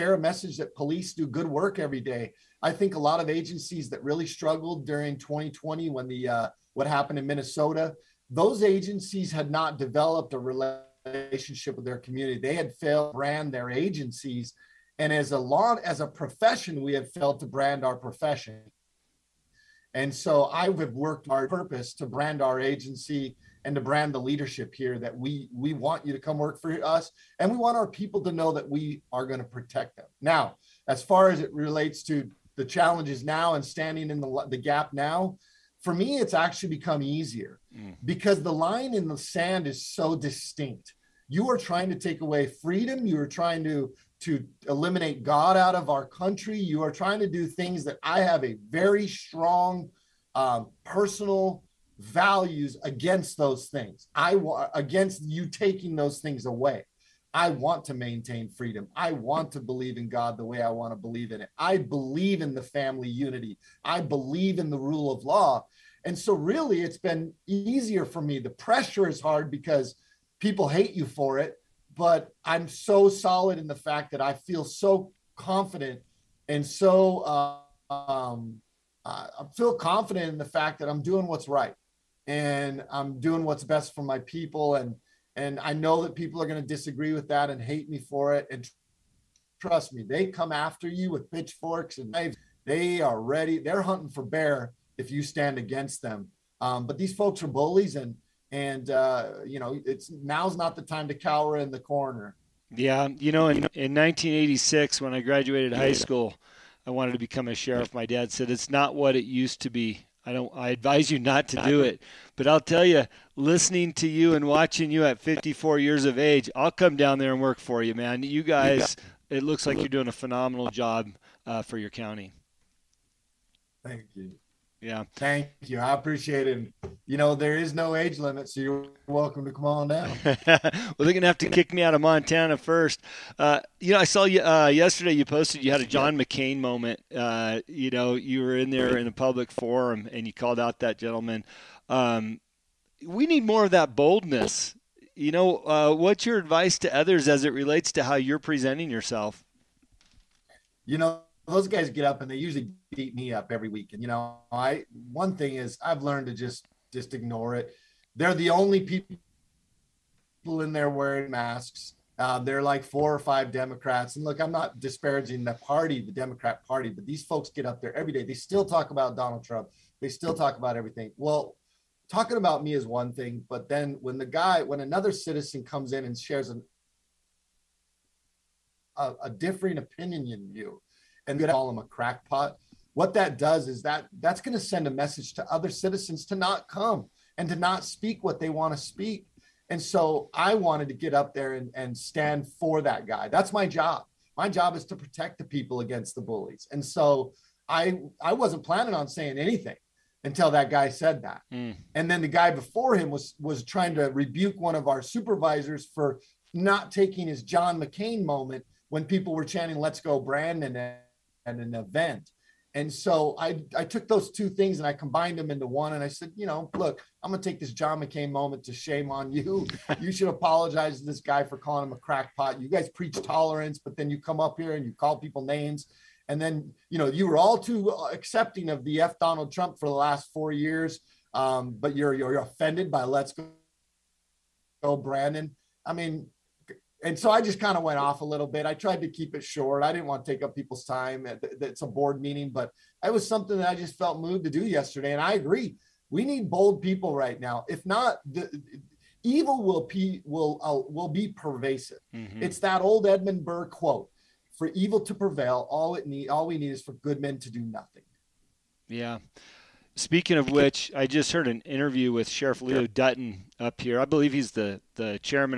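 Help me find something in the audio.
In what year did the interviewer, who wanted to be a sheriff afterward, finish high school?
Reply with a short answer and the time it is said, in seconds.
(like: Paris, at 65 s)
1986, at 103 s.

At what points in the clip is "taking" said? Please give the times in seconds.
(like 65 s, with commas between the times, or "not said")
55 s, 206 s.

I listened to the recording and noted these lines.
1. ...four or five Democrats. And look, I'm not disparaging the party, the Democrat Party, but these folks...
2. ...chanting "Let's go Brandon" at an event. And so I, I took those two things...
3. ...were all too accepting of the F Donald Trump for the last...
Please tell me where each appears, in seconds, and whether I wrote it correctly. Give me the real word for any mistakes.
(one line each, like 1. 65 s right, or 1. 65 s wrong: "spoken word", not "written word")
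1. 162 s right
2. 209 s right
3. 227 s right.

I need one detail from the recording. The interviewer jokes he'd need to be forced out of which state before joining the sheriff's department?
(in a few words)
Montana.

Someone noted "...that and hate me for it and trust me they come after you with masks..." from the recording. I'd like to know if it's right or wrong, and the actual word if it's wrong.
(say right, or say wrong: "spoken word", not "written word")
wrong: "pitchforks", not "masks".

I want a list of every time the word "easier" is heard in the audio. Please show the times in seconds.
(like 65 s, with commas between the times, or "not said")
37 s, 67 s.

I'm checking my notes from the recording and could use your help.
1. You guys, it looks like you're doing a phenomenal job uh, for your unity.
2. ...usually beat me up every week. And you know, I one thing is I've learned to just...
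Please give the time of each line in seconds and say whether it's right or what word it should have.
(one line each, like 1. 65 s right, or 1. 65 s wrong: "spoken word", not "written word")
1. 118 s wrong: "county", not "unity"
2. 152 s right.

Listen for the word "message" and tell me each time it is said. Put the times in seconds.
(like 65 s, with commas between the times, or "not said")
0 s, 184 s.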